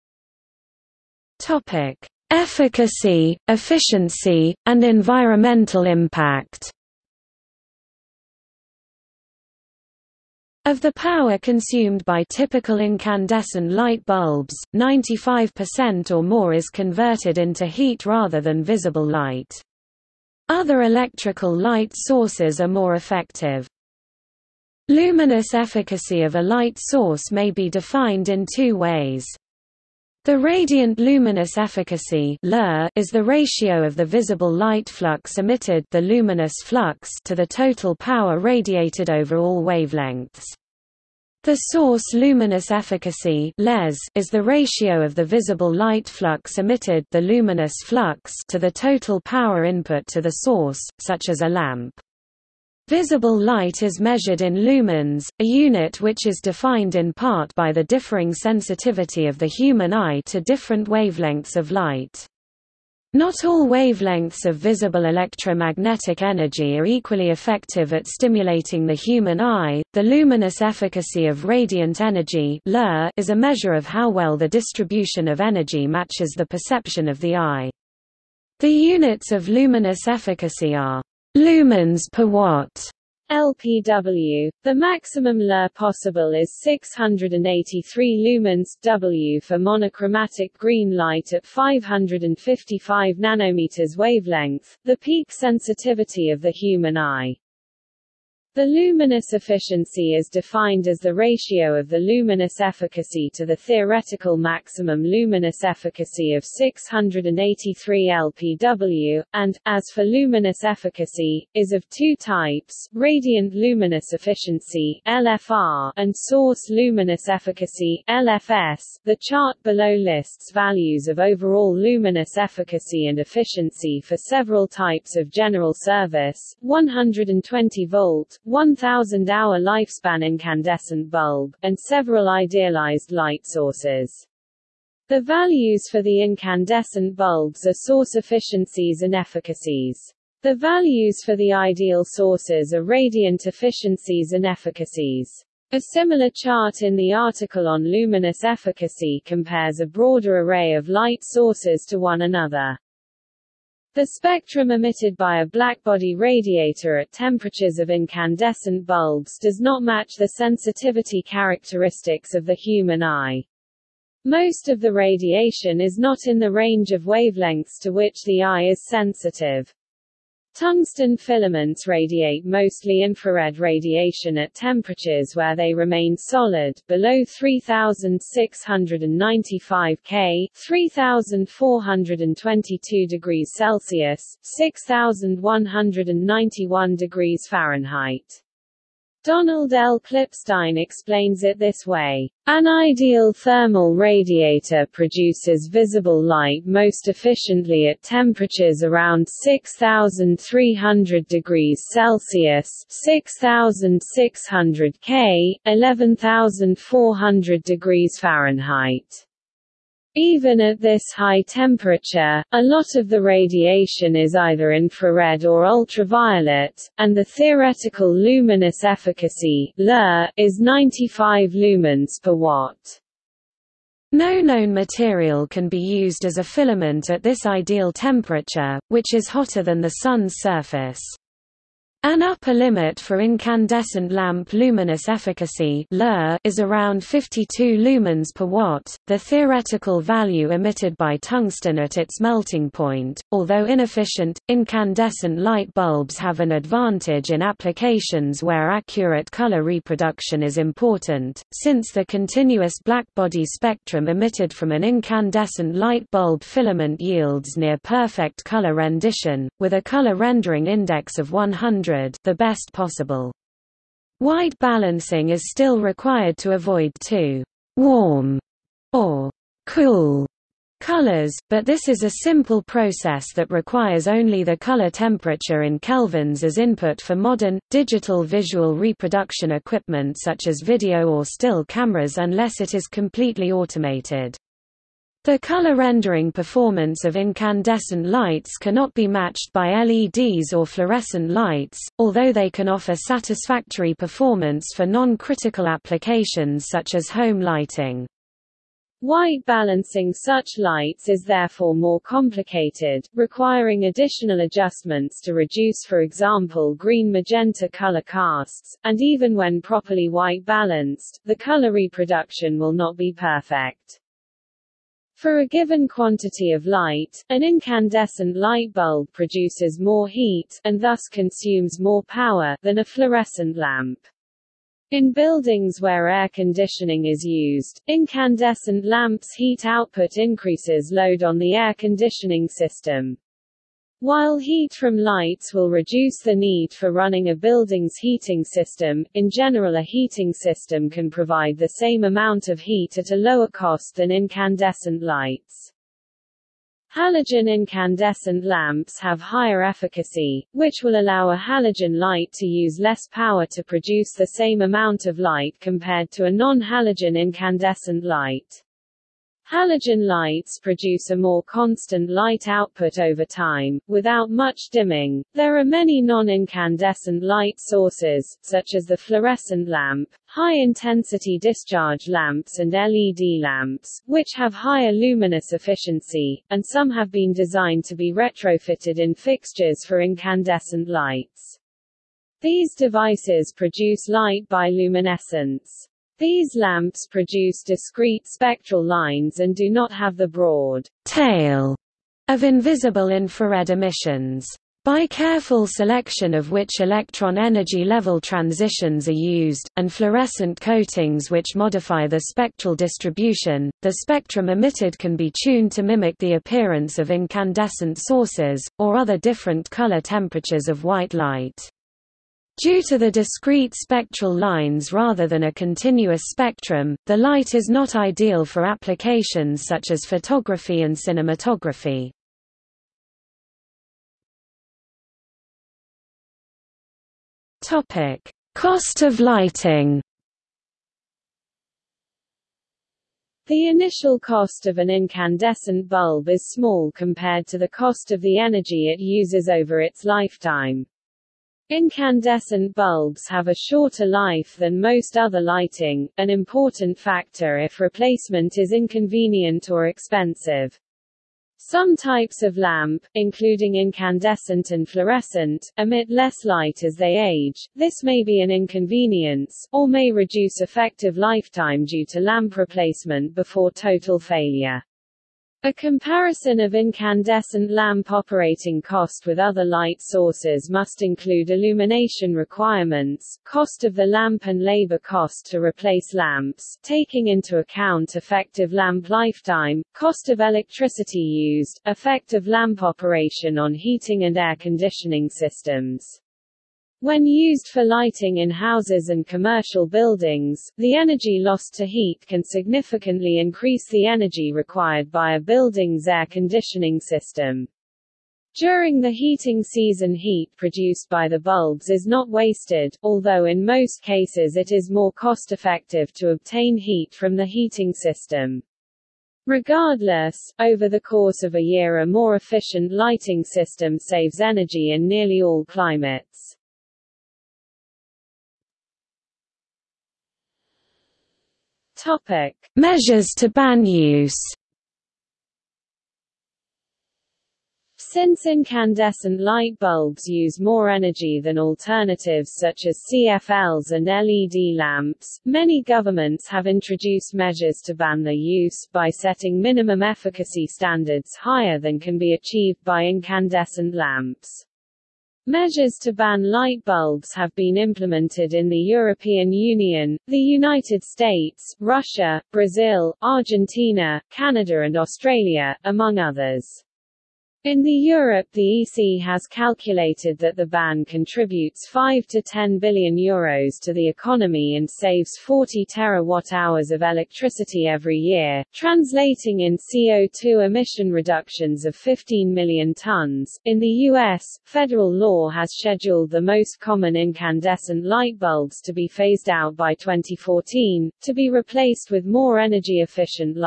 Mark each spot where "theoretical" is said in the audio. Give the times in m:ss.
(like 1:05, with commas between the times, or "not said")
1:43, 3:37, 3:59.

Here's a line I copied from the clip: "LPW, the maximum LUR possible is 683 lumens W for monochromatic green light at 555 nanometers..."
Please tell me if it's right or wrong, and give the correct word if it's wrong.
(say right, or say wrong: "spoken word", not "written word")
right.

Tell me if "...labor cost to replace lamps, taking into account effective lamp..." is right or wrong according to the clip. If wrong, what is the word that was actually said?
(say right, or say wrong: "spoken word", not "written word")
right.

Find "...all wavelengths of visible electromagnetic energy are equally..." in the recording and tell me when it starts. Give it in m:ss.
1:03.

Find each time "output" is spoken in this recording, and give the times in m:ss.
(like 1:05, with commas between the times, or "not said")
5:29, 6:02.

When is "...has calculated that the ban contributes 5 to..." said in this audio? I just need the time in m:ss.
9:19.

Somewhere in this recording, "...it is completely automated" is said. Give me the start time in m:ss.
4:42.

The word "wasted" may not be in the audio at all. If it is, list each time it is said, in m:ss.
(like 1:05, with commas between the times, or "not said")
8:22.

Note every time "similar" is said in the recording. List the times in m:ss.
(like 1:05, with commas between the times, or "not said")
2:25.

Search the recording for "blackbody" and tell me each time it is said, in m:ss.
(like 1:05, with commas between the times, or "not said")
2:35, 4:12.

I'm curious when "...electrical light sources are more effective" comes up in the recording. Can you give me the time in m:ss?
0:20.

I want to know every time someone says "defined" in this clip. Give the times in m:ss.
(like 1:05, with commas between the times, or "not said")
0:27, 0:56, 1:40.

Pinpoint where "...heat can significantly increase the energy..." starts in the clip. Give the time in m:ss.
8:11.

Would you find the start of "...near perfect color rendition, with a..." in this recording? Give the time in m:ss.
4:17.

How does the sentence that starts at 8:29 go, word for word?
Regardless, over the course of a year a more efficient lighting system saves energy in nearly all climates.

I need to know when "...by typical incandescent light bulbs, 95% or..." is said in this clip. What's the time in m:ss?
0:12.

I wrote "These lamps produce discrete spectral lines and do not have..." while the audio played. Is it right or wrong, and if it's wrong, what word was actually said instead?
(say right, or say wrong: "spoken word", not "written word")
right.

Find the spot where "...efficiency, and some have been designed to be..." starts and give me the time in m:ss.
6:15.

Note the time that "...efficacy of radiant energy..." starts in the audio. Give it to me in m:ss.
1:10.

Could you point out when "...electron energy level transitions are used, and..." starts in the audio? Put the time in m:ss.
6:36.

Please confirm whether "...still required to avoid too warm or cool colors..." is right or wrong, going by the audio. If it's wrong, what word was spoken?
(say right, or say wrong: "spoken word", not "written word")
right.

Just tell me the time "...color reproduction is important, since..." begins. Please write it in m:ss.
4:09.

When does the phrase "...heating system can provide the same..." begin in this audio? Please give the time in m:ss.
5:39.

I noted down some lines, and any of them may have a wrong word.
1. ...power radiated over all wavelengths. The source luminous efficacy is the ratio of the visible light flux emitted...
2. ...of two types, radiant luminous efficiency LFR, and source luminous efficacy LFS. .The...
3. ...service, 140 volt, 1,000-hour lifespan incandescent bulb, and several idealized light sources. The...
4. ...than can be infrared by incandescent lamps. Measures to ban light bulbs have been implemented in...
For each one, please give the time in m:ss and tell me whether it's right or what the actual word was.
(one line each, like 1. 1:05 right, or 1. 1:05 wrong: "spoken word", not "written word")
1. 0:37 right
2. 1:51 right
3. 2:05 wrong: "120", not "140"
4. 9:01 wrong: "achieved", not "infrared".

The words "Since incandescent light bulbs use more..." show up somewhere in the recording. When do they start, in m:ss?
8:47.